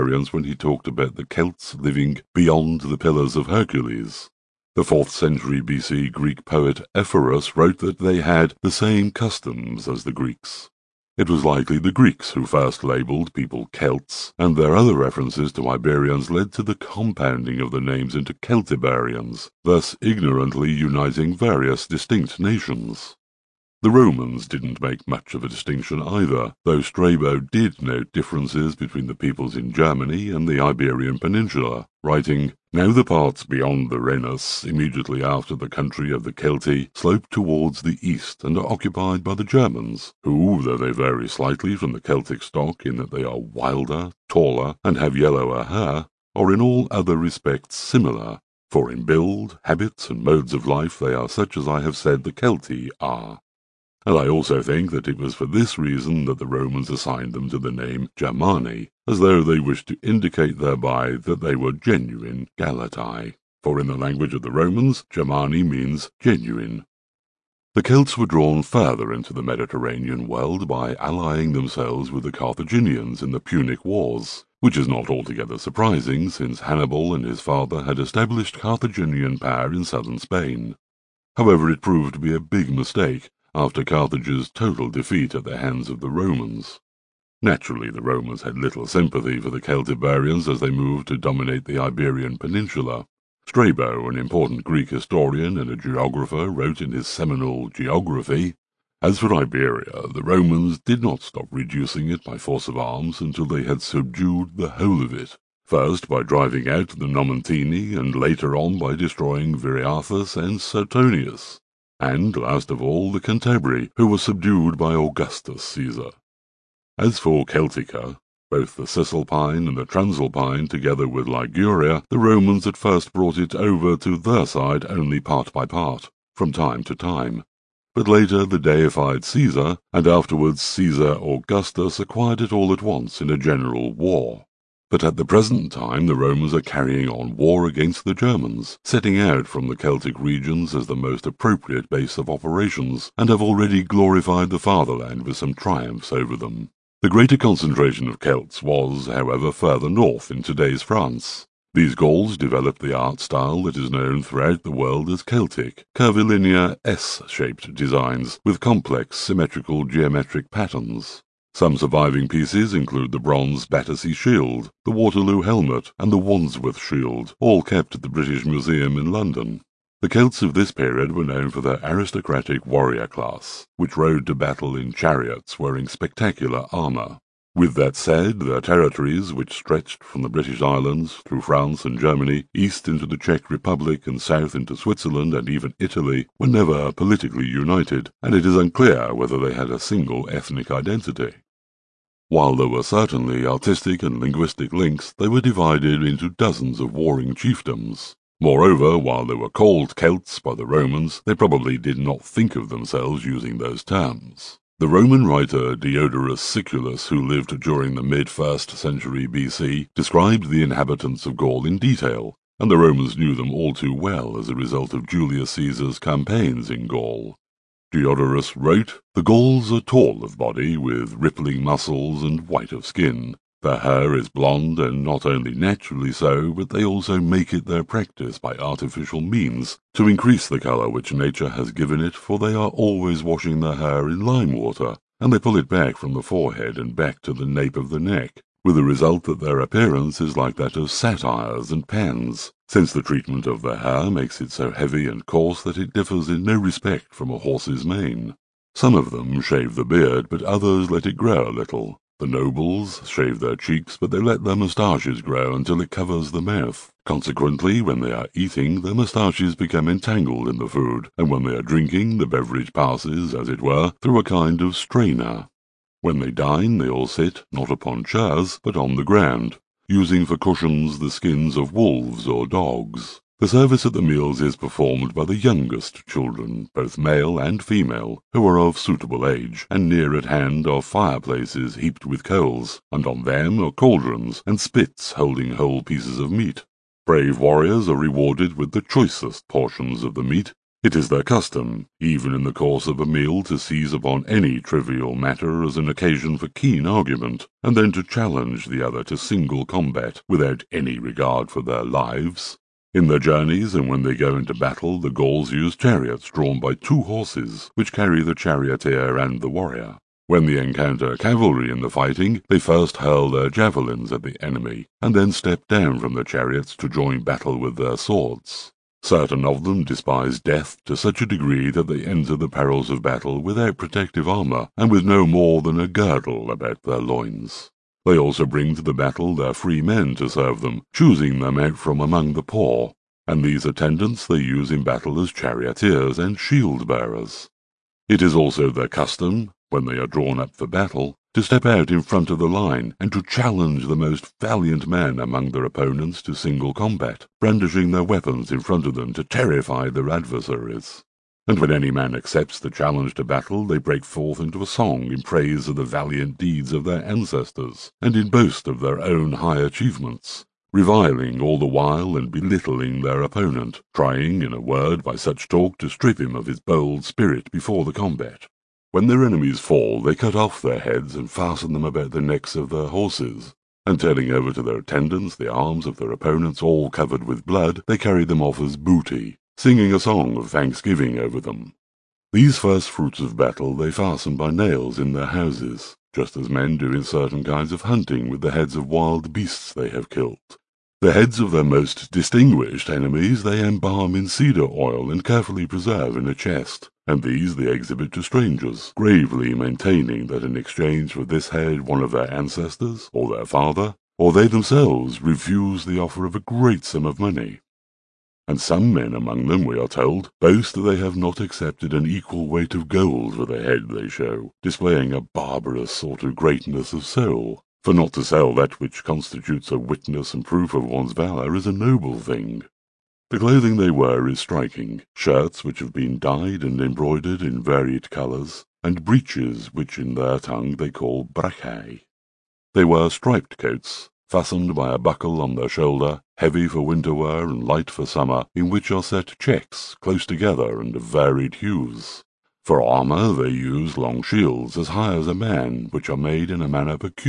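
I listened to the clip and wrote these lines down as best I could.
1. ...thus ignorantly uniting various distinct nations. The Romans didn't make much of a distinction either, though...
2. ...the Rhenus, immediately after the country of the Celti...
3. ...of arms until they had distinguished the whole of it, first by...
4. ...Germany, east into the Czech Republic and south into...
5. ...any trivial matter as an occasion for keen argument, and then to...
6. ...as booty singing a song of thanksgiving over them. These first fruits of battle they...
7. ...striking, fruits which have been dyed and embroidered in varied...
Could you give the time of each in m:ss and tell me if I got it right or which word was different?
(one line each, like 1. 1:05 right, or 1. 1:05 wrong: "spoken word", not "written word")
1. 0:19 right
2. 0:33 right
3. 1:42 wrong: "subdued", not "distinguished"
4. 3:01 right
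5. 4:54 right
6. 6:18 right
7. 7:04 wrong: "shirts", not "fruits".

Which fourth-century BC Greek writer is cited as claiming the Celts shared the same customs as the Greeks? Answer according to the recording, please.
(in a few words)
Ephorus.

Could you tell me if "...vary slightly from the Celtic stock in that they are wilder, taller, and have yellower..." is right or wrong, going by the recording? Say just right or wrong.
right.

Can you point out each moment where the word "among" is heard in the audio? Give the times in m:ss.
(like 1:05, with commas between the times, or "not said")
5:32, 5:45, 6:49.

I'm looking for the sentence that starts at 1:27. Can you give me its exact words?
Naturally, the Romans had little sympathy for the Celtiberians as they moved to dominate the Iberian Peninsula.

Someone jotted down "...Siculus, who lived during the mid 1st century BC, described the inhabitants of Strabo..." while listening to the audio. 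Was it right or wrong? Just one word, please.
wrong.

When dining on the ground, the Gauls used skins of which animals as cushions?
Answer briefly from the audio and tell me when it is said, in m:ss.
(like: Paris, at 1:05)
wolves or dogs, at 4:31.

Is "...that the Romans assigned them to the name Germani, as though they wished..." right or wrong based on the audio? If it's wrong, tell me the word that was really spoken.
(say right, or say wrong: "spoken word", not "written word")
right.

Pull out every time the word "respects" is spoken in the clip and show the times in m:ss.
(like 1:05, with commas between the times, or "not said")
0:47, 4:06.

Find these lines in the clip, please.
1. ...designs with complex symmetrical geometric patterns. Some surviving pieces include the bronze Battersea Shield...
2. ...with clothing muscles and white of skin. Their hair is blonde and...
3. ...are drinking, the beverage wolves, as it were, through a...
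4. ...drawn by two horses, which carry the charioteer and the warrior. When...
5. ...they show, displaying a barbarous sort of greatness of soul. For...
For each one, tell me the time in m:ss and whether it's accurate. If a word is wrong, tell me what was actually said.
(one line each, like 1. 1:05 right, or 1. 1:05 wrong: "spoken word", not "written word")
1. 2:37 right
2. 3:40 wrong: "rippling", not "clothing"
3. 4:21 wrong: "passes", not "wolves"
4. 5:06 right
5. 6:53 right.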